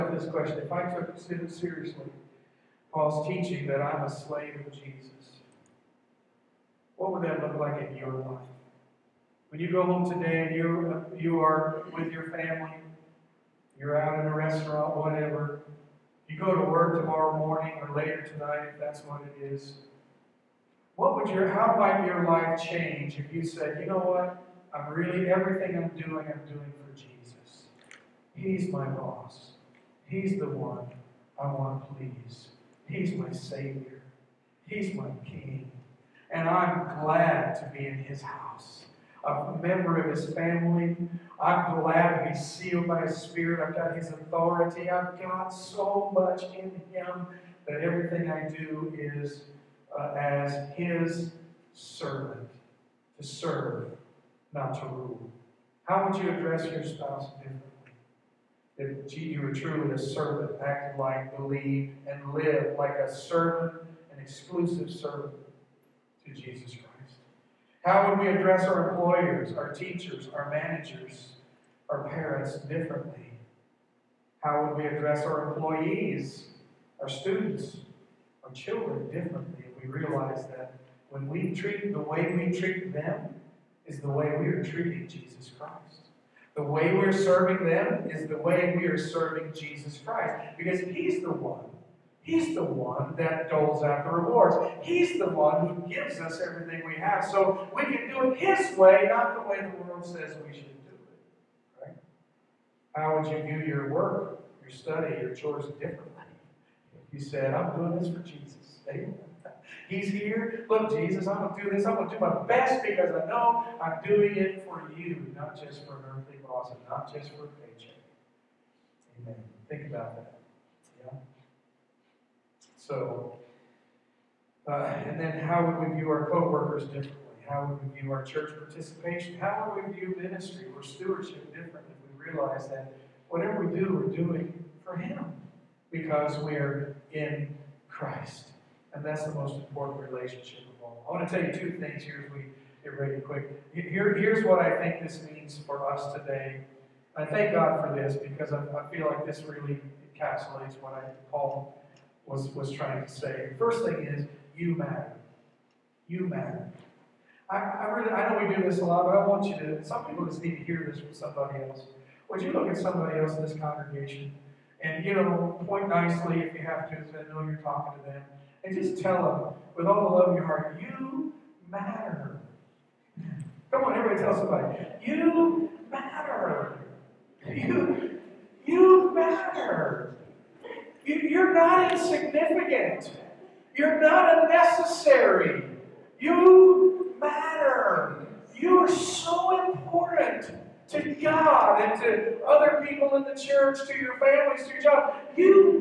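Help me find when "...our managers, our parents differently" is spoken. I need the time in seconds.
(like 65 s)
70 s.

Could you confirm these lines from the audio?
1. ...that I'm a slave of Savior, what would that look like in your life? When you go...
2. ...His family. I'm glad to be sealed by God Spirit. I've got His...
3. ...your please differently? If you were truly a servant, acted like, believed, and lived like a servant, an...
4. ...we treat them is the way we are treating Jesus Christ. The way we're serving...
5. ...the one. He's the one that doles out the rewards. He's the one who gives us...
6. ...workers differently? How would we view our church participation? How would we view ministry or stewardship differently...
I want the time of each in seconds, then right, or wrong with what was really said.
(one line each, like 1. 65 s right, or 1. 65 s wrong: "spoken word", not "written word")
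1. 3 s wrong: "Jesus", not "Savior"
2. 40 s wrong: "His", not "God"
3. 56 s wrong: "spouse", not "please"
4. 82 s right
5. 91 s right
6. 126 s right.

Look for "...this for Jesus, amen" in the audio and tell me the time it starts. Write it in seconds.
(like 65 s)
107 s.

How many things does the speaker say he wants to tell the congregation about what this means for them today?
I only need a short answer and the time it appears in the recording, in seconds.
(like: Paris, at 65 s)
2, at 141 s.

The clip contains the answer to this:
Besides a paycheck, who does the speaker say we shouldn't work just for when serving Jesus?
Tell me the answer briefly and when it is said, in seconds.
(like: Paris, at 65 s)
an earthly boss, at 115 s.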